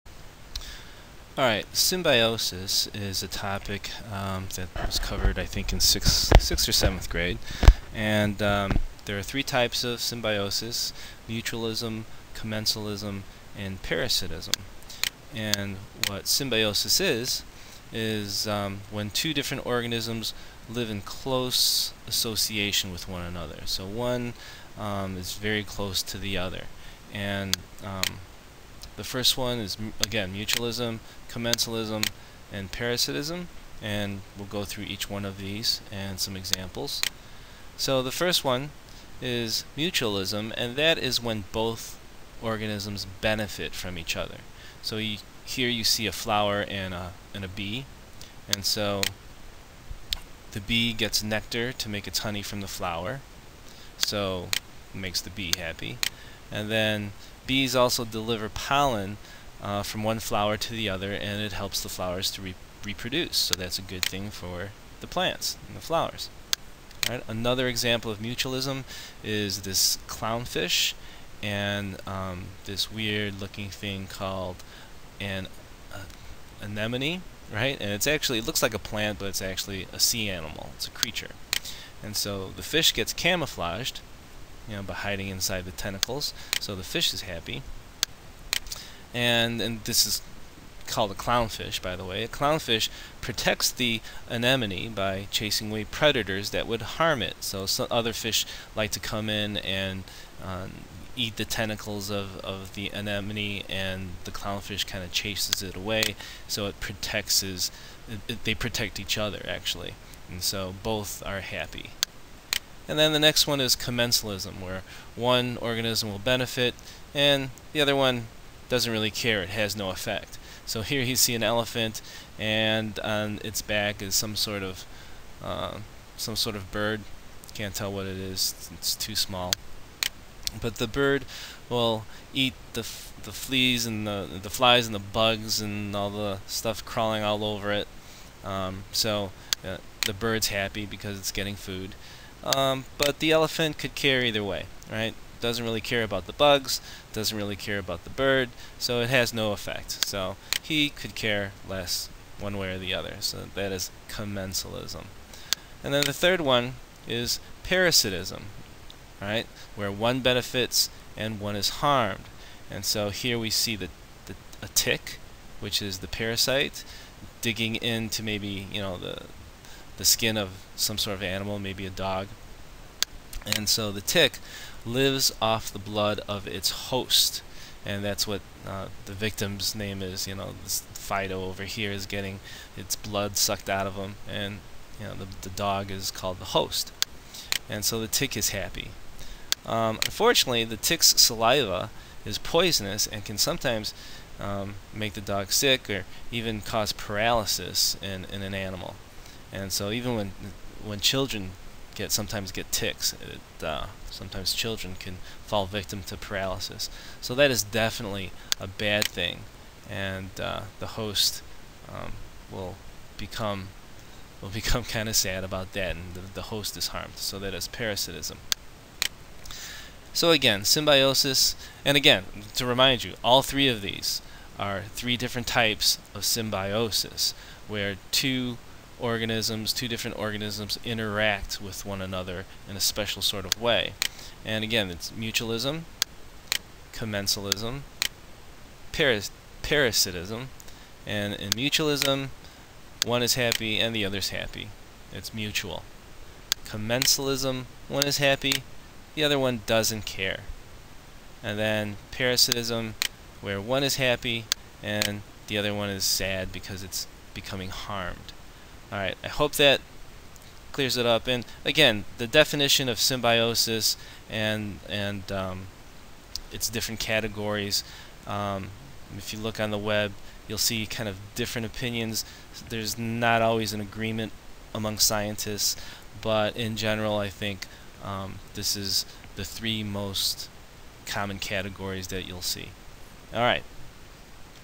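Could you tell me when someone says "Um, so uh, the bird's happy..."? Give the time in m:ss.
2:18.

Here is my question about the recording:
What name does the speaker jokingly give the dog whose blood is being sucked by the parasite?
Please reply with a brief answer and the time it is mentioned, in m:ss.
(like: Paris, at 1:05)
Fido, at 3:00.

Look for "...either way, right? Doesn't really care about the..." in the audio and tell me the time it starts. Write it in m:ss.
2:24.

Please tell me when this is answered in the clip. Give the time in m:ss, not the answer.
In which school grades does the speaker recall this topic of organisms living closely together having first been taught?
0:06.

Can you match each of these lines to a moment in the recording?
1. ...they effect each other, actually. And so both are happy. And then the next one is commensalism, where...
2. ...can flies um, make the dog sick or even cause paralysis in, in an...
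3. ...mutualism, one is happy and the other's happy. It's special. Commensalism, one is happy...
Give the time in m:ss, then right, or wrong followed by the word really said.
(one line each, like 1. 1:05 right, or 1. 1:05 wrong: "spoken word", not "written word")
1. 1:48 wrong: "protect", not "effect"
2. 3:13 wrong: "sometimes", not "flies"
3. 4:01 wrong: "mutual", not "special".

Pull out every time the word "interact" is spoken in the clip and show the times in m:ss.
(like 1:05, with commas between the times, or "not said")
3:50.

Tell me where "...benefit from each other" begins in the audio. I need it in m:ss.
0:43.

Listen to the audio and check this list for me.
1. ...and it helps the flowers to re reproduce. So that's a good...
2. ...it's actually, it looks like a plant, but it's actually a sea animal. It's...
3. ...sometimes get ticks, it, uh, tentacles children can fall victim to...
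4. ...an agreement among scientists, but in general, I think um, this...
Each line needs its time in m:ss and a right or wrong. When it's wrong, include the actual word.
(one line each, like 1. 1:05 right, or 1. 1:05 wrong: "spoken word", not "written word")
1. 1:01 right
2. 1:17 right
3. 3:22 wrong: "sometimes", not "tentacles"
4. 4:33 right.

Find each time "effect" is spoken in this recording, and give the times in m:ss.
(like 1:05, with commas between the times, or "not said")
1:59, 2:29.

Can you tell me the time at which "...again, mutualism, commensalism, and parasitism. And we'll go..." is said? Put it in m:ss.
0:30.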